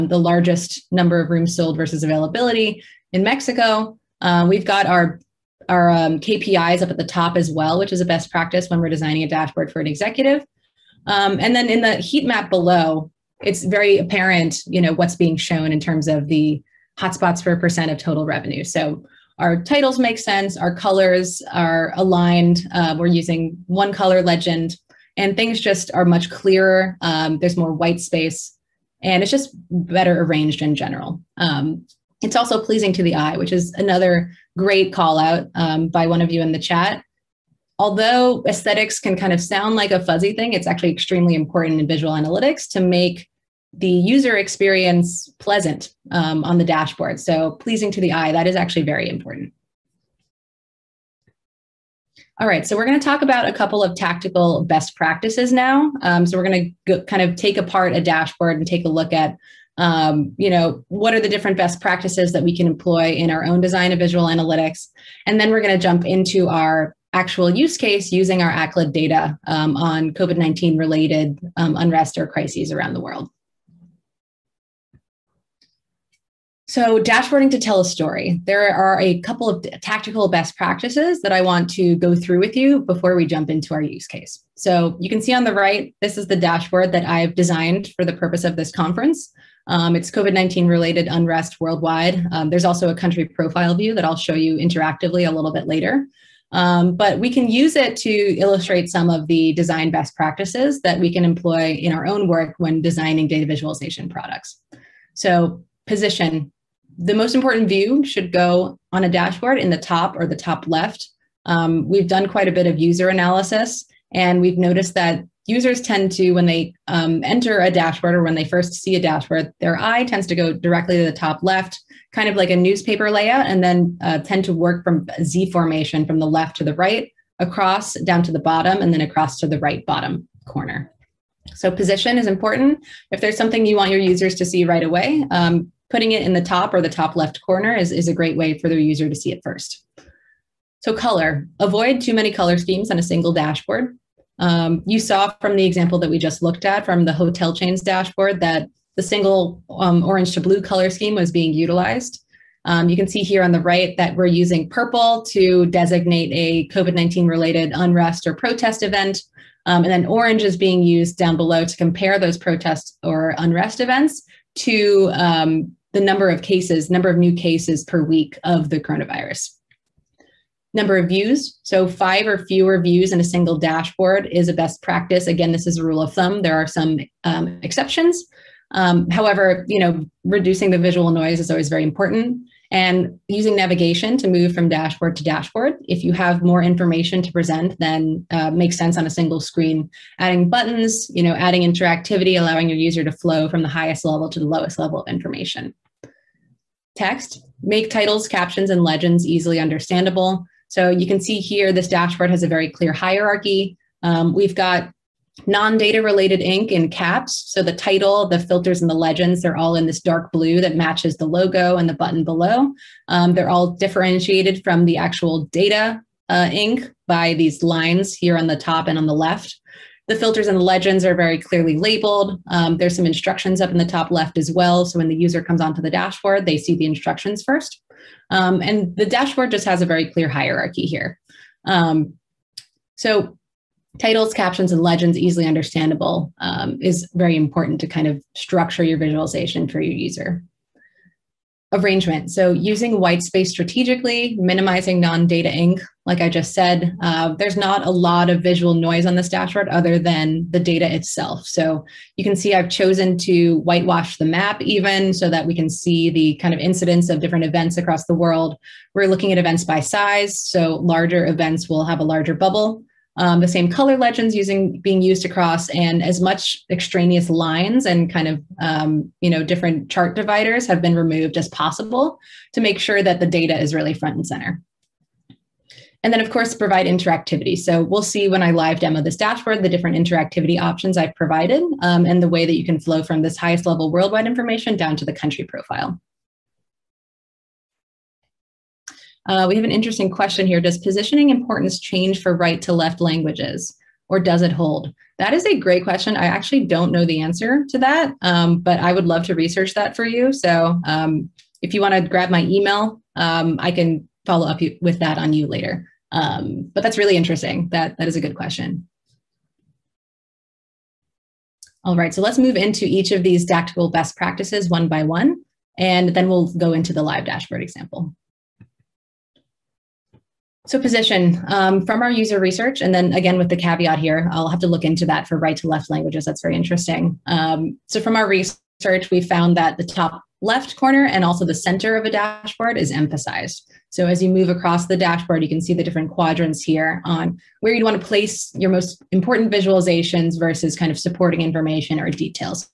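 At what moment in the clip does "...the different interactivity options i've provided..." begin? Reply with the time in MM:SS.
04:39.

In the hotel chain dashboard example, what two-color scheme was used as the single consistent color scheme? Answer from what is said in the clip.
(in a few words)
Orange to blue.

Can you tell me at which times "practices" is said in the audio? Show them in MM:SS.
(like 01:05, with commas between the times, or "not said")
00:08, 00:54, 01:01, 01:20, 01:40, 02:54, 05:14.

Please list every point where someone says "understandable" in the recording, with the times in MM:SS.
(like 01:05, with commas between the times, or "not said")
03:19, 03:55.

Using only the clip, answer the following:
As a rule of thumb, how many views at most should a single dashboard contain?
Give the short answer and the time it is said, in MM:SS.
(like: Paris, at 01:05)
5, at 02:51.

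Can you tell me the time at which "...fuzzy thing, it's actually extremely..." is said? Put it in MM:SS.
00:40.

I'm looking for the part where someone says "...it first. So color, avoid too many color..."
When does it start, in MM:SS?
02:19.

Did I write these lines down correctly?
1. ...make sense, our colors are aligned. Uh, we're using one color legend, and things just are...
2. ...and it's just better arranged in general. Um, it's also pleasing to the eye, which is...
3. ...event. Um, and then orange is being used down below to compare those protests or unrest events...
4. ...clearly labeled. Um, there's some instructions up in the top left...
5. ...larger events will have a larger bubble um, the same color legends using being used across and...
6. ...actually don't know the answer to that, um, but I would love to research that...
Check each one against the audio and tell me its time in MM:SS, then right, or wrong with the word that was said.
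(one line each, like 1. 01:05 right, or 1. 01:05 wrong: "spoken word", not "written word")
1. 00:19 right
2. 00:29 right
3. 02:38 right
4. 03:41 right
5. 04:20 right
6. 04:56 right.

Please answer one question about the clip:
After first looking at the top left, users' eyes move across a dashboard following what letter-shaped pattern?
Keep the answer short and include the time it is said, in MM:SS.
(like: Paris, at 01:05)
Z formation, at 02:05.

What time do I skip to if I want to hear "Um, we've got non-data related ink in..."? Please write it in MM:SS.
03:24.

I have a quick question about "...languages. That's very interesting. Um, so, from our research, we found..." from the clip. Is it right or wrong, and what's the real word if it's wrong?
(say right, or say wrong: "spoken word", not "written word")
right.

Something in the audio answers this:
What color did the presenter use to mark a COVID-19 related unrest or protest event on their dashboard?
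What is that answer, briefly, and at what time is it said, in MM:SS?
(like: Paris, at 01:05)
Purple, at 02:34.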